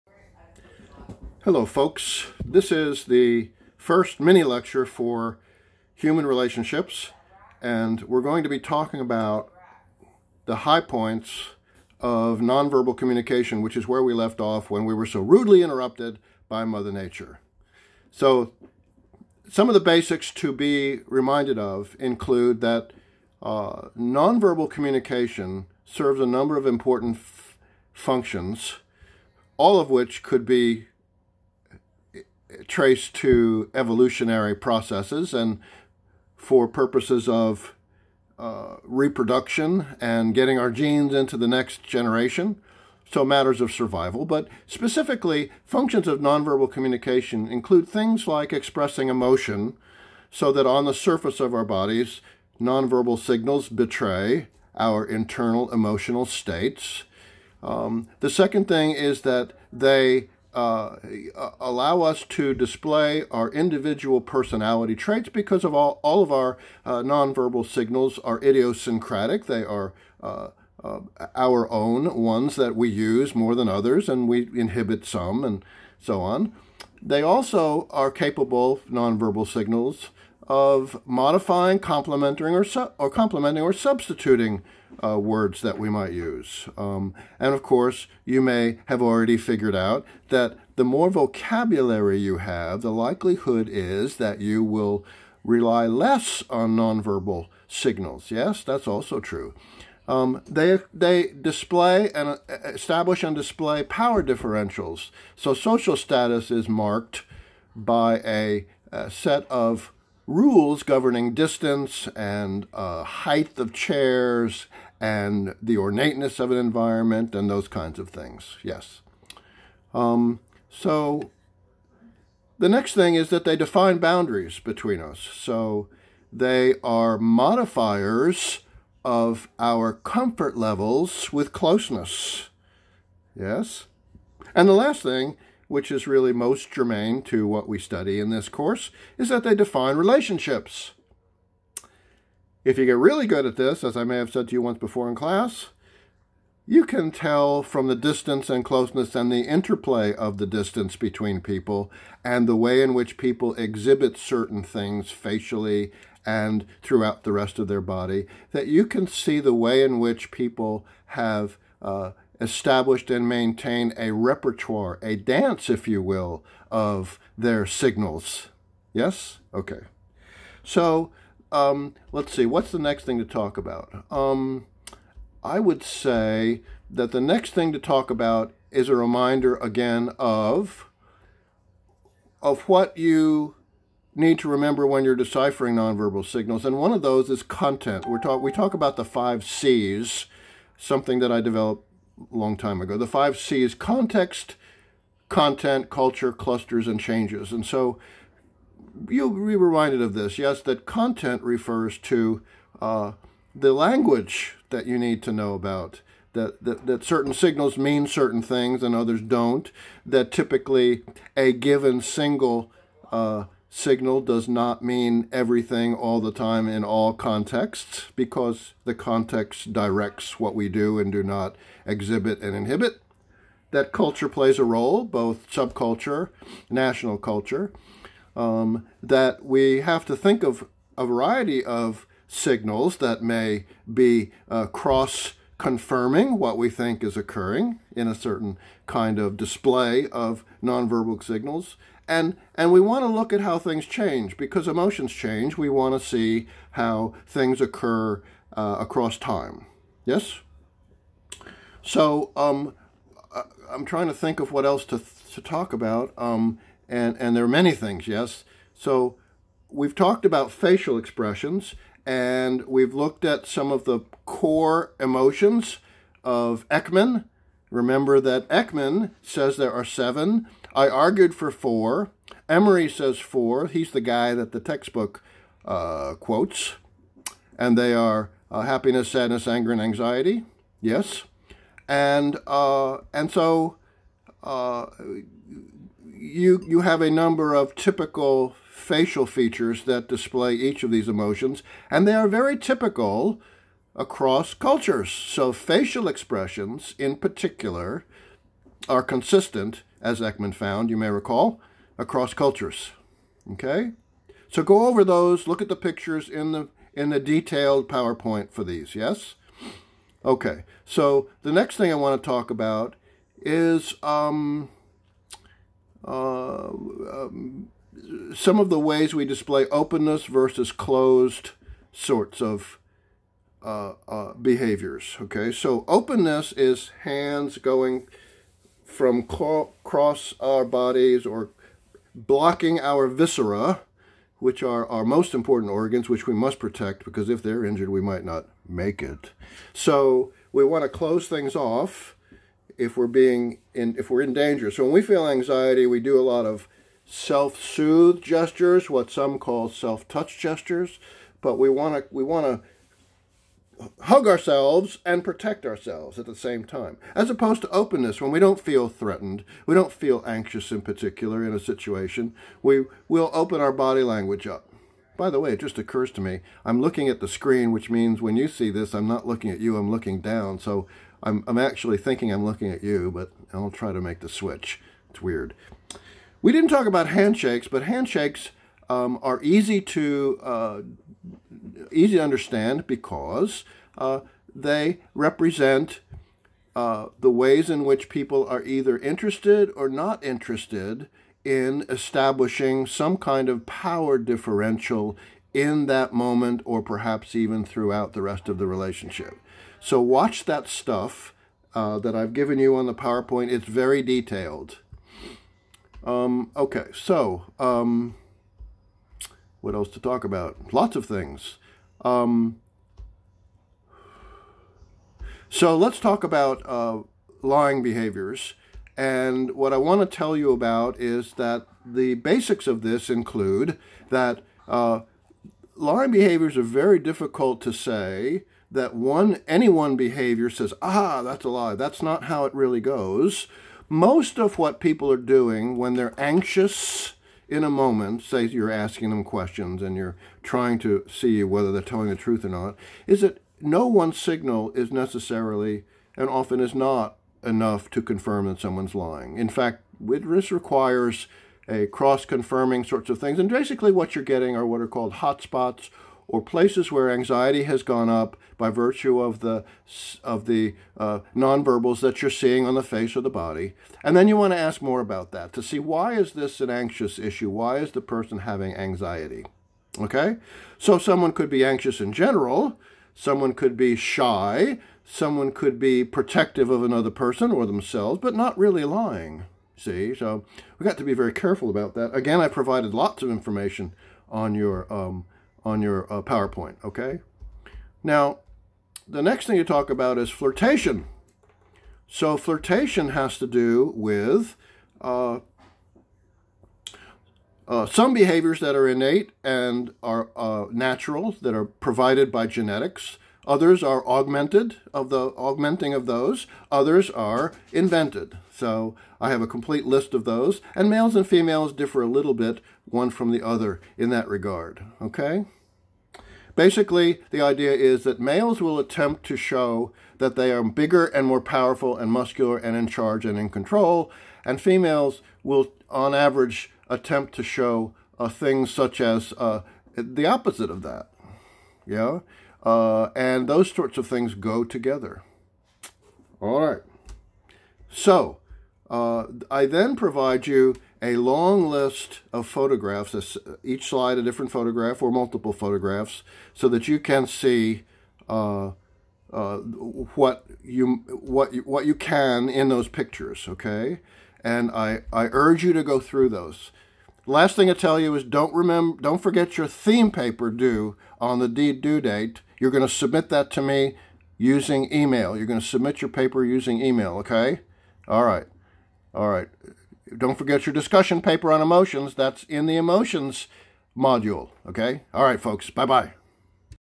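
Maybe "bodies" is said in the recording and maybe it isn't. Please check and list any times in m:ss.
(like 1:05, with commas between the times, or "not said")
0:51, 5:30.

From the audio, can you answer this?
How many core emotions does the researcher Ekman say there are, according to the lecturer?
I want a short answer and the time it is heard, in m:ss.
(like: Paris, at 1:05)
7, at 4:29.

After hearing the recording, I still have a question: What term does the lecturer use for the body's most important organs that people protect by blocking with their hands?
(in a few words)
viscera.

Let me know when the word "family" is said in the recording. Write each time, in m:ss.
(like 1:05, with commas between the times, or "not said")
not said.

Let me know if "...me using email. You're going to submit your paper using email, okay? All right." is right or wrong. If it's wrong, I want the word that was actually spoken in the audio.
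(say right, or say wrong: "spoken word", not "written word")
right.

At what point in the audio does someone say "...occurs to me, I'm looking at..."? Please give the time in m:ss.
6:05.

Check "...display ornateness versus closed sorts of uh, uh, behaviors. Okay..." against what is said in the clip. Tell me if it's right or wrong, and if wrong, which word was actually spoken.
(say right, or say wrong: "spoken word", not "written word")
wrong: "openness", not "ornateness".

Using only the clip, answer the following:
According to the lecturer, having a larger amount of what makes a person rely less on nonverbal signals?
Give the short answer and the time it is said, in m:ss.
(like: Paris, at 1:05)
vocabulary, at 1:31.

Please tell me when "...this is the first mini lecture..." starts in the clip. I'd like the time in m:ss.
0:02.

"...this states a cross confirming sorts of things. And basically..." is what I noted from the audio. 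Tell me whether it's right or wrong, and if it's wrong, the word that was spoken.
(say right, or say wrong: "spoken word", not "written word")
wrong: "requires", not "states".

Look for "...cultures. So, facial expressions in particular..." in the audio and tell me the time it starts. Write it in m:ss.
4:54.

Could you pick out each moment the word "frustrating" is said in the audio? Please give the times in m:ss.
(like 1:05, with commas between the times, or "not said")
not said.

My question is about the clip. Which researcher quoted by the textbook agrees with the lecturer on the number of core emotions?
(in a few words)
Emery.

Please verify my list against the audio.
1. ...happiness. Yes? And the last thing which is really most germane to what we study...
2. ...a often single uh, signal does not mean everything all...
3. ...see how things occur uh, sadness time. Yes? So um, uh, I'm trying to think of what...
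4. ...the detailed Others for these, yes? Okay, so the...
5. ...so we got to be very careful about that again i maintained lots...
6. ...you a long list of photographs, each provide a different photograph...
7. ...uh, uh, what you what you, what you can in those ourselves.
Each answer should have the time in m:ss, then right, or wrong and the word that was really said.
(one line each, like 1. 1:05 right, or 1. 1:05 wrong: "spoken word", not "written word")
1. 2:11 wrong: "closeness", not "happiness"
2. 3:31 wrong: "given", not "often"
3. 4:06 wrong: "across", not "sadness"
4. 5:07 wrong: "PowerPoint", not "Others"
5. 8:00 wrong: "provided", not "maintained"
6. 9:00 wrong: "slide", not "provide"
7. 9:08 wrong: "pictures", not "ourselves".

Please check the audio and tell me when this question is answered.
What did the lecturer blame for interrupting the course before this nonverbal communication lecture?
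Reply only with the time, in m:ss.
0:16.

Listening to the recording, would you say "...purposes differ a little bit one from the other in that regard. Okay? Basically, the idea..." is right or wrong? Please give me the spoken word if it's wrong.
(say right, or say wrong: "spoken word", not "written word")
wrong: "females", not "purposes".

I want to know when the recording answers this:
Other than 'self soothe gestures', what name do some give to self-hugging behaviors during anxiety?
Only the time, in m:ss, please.
5:49.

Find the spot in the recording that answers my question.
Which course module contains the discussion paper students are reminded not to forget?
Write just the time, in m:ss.
9:32.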